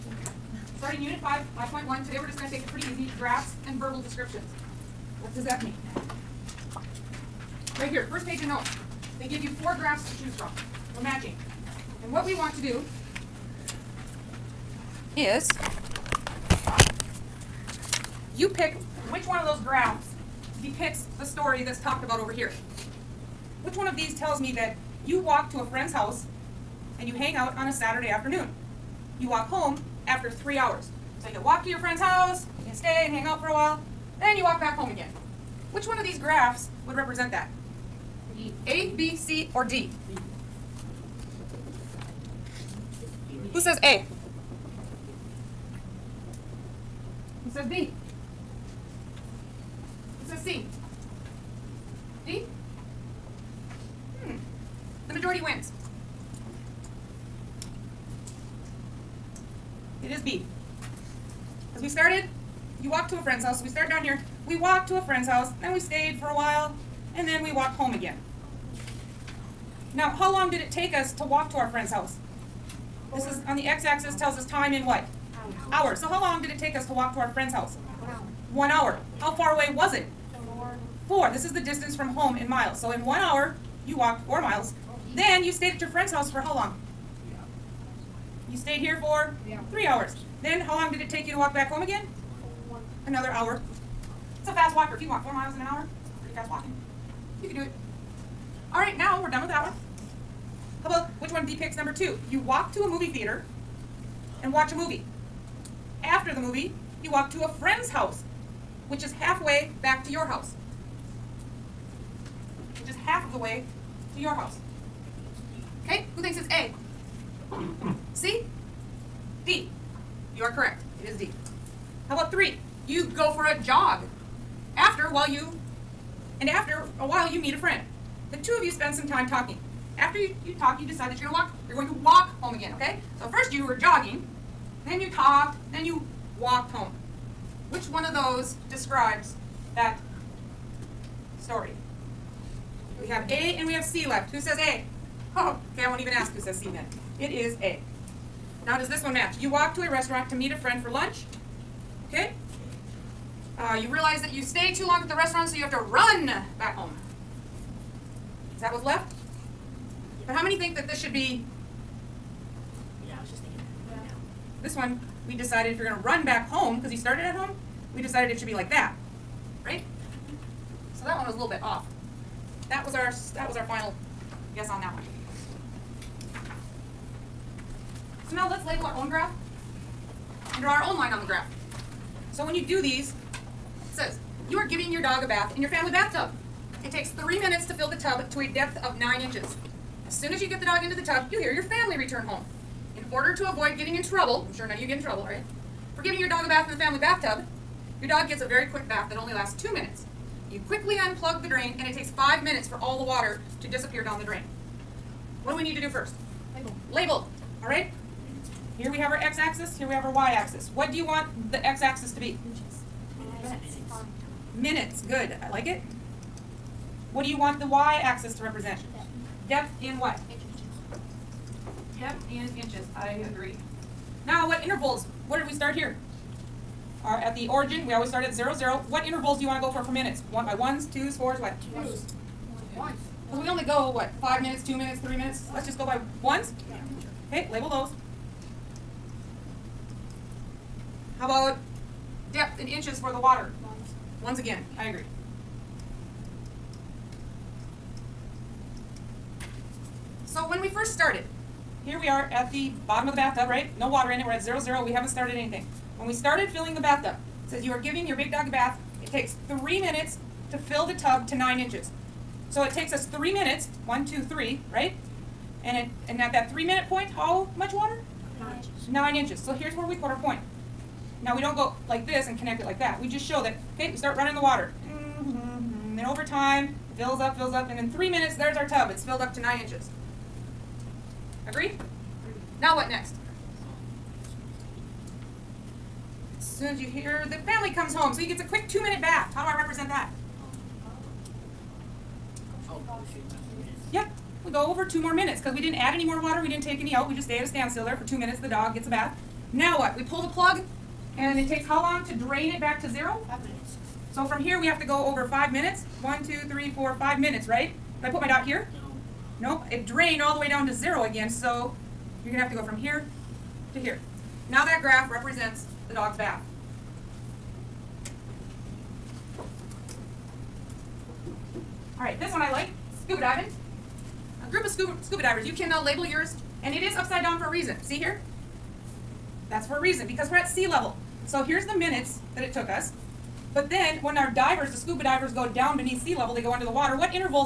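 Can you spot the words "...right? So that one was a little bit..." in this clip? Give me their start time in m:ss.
2:49.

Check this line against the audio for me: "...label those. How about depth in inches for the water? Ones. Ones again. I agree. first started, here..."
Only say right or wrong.
right.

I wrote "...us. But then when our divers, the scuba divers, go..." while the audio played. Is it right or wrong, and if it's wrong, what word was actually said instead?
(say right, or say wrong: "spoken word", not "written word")
right.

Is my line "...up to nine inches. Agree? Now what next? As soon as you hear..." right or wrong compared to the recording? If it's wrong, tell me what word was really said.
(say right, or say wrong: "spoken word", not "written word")
right.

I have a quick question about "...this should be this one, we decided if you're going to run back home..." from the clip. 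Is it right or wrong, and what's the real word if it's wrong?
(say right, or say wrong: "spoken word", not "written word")
right.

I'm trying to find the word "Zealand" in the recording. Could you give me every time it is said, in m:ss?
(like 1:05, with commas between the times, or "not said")
not said.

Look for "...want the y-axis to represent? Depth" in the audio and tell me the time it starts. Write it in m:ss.
3:37.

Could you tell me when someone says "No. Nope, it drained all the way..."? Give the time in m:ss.
5:09.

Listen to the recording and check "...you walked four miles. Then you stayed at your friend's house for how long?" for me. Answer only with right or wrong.
right.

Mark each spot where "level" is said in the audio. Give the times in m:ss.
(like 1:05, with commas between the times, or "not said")
5:30, 5:36.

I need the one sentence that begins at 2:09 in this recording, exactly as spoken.
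After you, you talk, you decide that you're going to walk.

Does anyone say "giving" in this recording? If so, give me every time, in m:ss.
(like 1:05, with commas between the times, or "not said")
3:04, 3:16, 4:17.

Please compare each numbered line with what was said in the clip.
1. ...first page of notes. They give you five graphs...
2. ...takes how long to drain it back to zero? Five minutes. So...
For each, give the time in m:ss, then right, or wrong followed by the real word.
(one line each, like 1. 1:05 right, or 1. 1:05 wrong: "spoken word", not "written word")
1. 0:08 wrong: "four", not "five"
2. 5:01 right.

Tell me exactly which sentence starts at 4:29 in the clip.
So here's where we put our point.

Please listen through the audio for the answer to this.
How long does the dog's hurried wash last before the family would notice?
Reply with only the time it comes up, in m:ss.
3:19.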